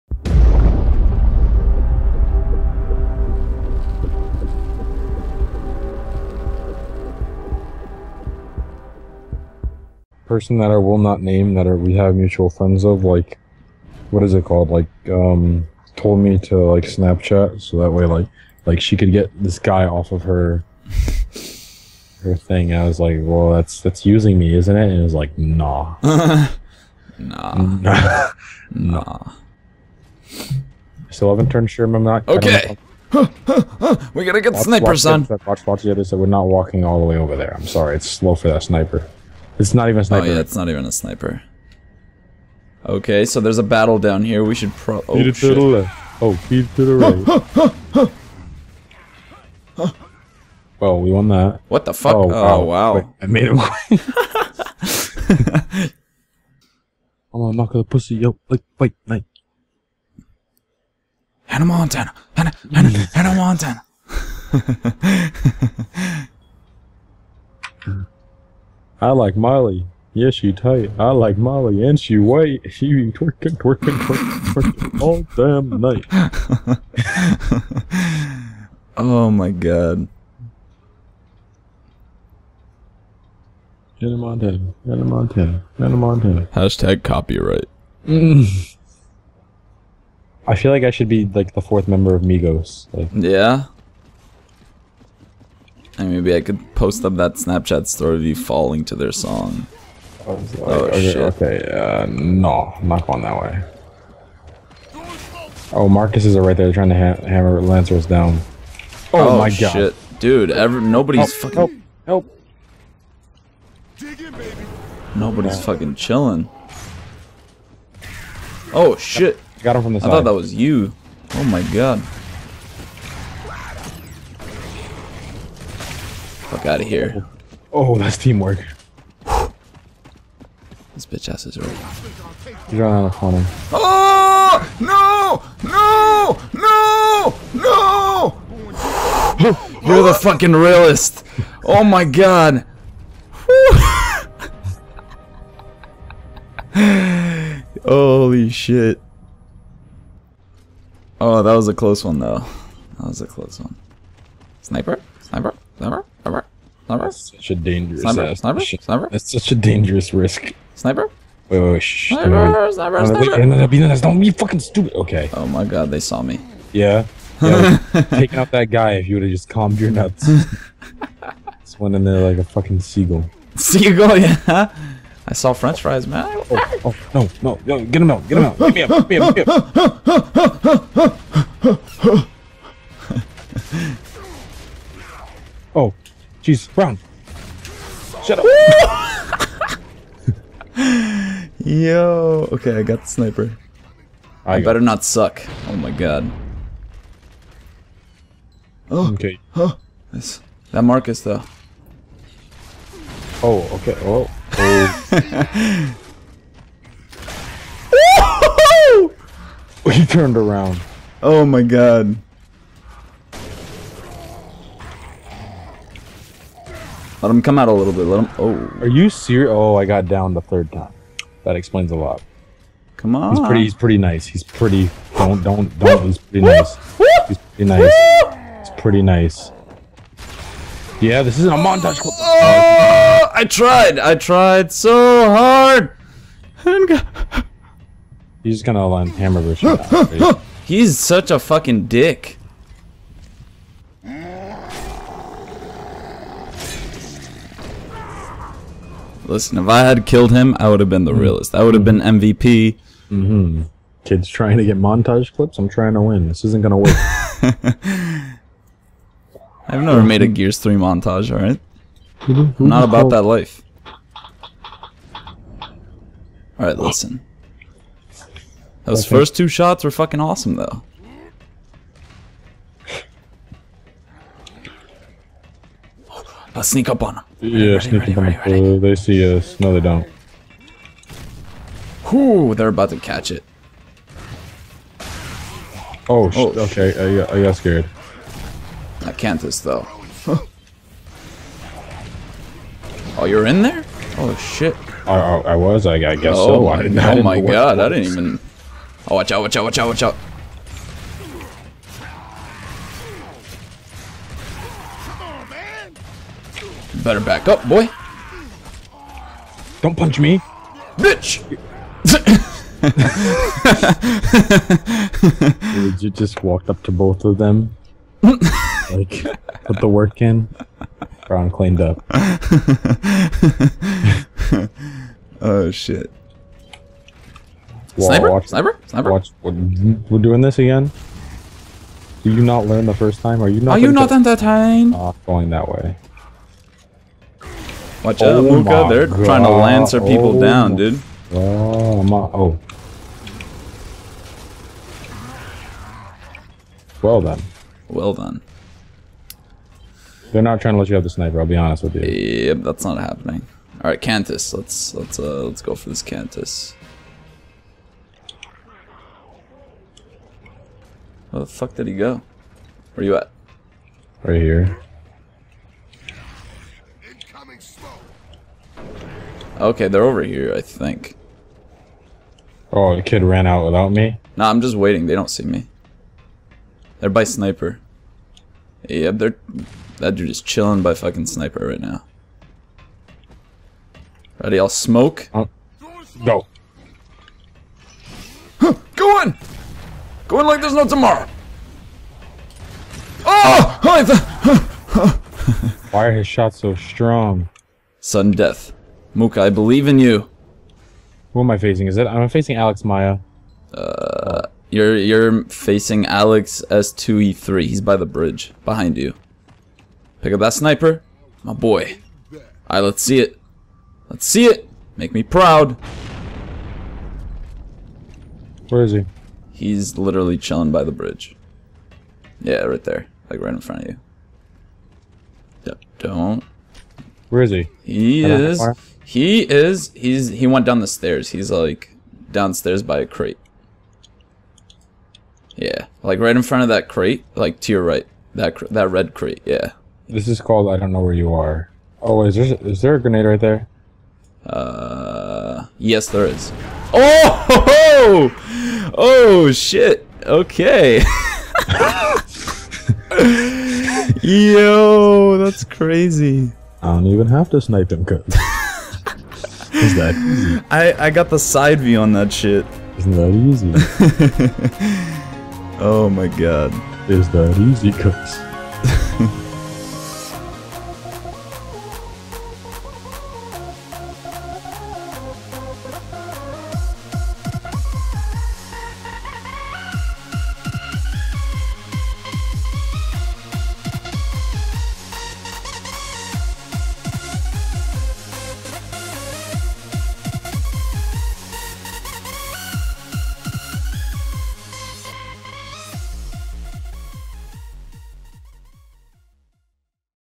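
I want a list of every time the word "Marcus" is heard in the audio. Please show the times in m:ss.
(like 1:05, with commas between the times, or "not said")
1:45, 3:20.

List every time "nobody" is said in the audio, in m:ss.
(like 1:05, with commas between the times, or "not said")
1:50, 1:55.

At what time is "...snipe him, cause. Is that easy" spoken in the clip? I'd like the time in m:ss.
7:37.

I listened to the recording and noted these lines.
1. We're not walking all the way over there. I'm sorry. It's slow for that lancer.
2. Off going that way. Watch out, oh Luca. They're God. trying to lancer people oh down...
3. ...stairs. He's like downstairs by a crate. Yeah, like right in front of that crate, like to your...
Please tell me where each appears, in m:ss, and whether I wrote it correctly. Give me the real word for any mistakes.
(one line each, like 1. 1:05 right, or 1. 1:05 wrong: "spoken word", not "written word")
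1. 0:36 wrong: "sniper", not "lancer"
2. 5:34 right
3. 7:10 right.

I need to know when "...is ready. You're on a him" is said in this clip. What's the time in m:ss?
2:11.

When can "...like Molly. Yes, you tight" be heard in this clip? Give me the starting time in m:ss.
1:09.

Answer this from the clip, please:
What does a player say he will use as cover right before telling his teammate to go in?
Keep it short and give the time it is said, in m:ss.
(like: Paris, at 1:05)
Smoke, at 6:24.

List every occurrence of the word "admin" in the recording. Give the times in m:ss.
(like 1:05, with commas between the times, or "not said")
not said.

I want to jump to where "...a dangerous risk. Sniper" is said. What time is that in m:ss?
2:39.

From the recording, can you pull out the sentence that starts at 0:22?
I was like, well, that's that's using me, isn't it?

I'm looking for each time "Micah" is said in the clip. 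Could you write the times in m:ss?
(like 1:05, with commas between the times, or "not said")
not said.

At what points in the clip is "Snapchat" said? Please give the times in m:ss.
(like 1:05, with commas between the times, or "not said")
0:16, 1:37.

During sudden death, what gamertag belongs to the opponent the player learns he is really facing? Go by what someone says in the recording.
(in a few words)
Alex S2E3.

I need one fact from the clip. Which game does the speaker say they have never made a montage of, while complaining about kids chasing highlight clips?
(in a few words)
Gears 3.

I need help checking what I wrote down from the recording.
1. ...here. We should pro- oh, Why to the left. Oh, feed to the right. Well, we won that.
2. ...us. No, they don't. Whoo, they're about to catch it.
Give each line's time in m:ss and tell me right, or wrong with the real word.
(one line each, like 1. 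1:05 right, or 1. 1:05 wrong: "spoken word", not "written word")
1. 0:44 wrong: "Feed", not "Why"
2. 4:39 right.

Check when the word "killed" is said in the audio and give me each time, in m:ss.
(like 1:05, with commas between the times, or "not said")
4:10.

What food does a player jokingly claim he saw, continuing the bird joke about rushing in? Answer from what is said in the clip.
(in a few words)
French fries.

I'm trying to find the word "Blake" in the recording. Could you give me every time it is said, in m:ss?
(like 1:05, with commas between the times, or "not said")
not said.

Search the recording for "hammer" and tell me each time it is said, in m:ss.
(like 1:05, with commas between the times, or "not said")
1:47, 3:59.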